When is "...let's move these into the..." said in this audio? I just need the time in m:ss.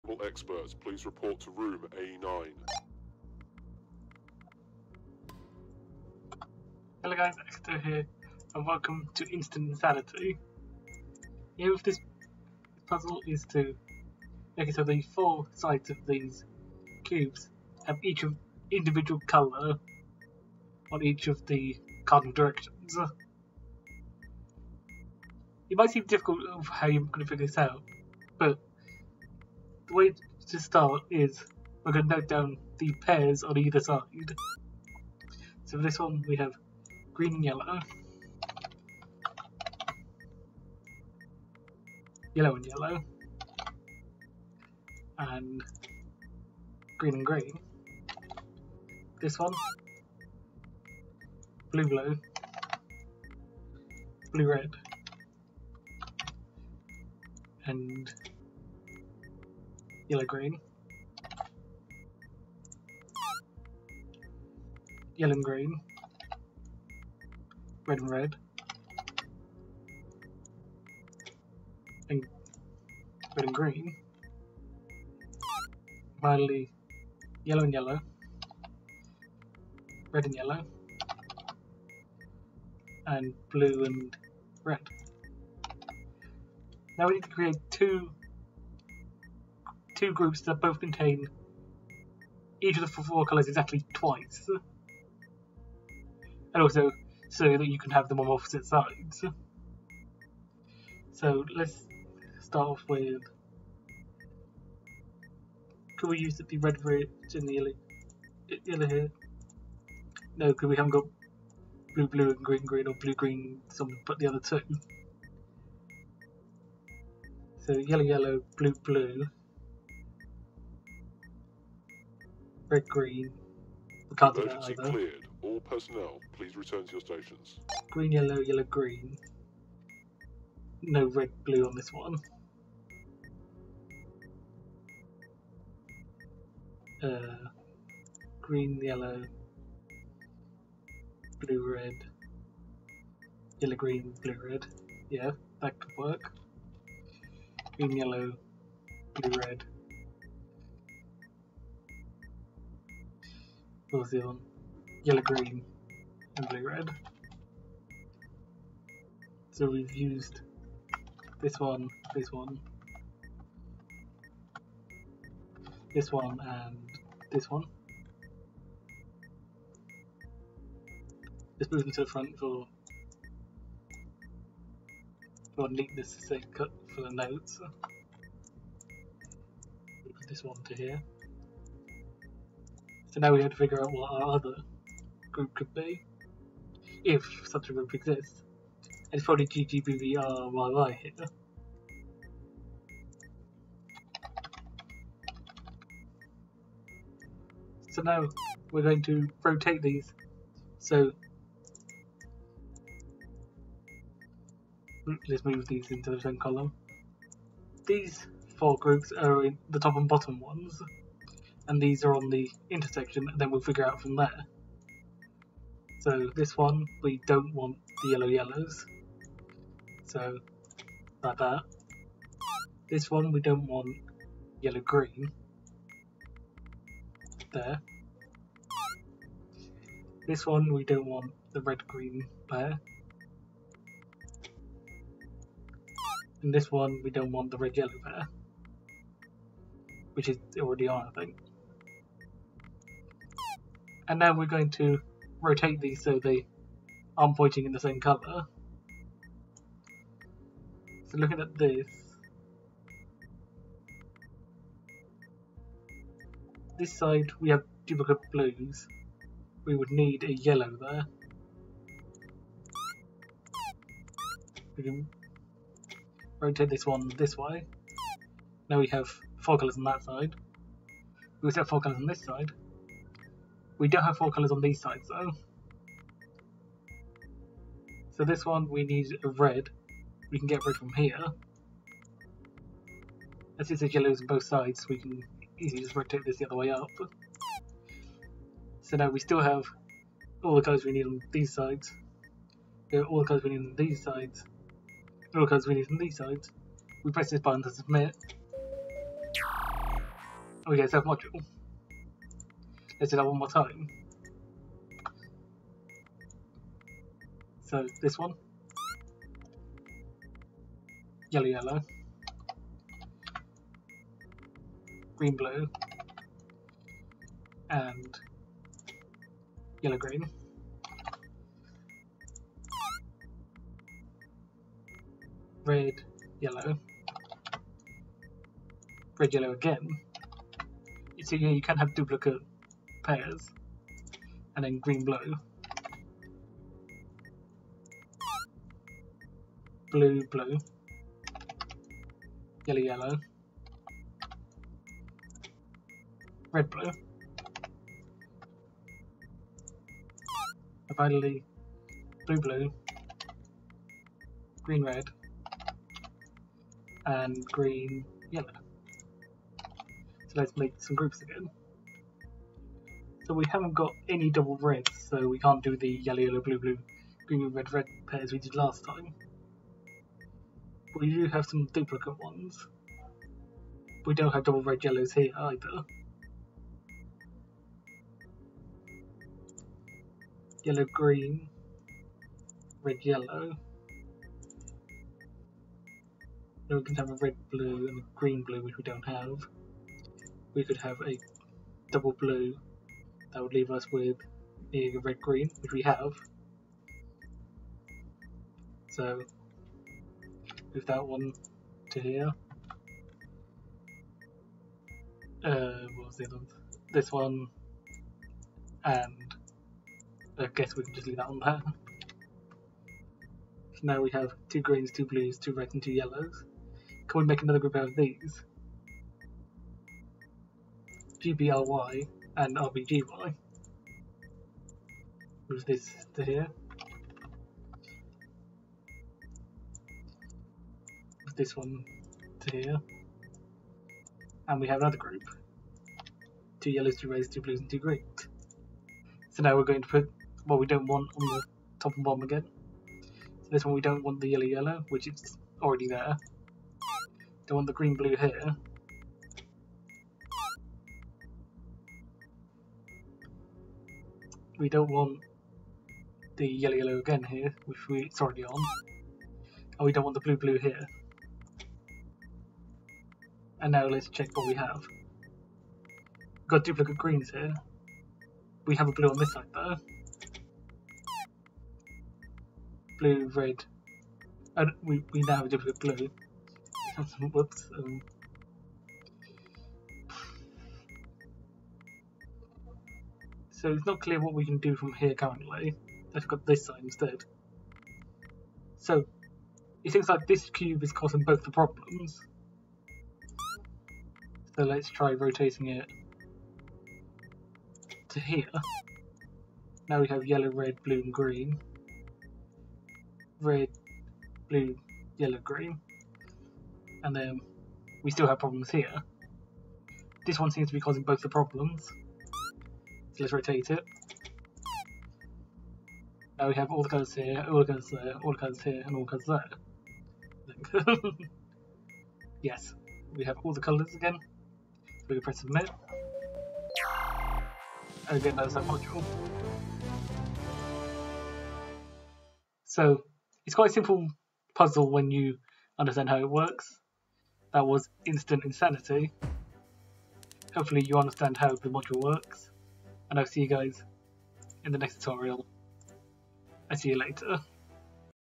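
3:25.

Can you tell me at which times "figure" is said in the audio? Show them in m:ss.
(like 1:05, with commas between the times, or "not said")
0:27, 3:03, 3:33.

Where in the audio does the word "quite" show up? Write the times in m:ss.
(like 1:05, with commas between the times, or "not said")
8:53.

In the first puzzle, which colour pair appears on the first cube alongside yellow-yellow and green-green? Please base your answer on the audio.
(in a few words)
green and yellow.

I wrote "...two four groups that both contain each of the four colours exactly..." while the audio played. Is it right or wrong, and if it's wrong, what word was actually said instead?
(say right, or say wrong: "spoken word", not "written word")
wrong: "two", not "four".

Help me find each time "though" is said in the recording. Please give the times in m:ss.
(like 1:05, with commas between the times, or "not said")
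4:35, 7:49.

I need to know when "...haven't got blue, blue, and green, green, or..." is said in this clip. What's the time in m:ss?
1:50.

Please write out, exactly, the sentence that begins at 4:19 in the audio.
We would need a yellow there.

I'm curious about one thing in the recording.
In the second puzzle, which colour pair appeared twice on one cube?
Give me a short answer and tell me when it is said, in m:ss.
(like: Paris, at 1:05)
red and yellow, at 5:29.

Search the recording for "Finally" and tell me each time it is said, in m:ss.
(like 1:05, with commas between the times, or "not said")
1:16, 5:50.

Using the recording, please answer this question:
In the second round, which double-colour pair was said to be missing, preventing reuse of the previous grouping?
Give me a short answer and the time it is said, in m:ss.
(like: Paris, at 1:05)
double reds, at 6:04.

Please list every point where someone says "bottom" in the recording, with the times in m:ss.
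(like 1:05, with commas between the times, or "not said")
3:30, 7:22.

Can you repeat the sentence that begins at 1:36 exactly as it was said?
And also, so that you can have them on opposite sides.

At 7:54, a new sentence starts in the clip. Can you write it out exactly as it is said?
And we, we now have a duplicate blue.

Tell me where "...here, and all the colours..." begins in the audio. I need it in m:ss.
8:38.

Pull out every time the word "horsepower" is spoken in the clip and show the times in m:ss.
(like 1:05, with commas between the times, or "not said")
not said.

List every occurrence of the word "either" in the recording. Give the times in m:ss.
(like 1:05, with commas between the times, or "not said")
0:33, 2:04, 6:15.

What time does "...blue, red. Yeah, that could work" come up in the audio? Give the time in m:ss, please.
2:24.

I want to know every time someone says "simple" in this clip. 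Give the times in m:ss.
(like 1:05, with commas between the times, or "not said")
8:53.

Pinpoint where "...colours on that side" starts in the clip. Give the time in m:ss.
4:29.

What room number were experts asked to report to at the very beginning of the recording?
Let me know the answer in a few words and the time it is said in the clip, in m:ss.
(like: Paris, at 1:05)
A9, at 0:01.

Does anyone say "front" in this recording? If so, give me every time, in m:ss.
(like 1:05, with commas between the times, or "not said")
2:52.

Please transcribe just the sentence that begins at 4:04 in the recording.
And now we're going to rotate these so they aren't pointing in the same colour.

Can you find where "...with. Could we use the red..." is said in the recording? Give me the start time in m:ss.
1:42.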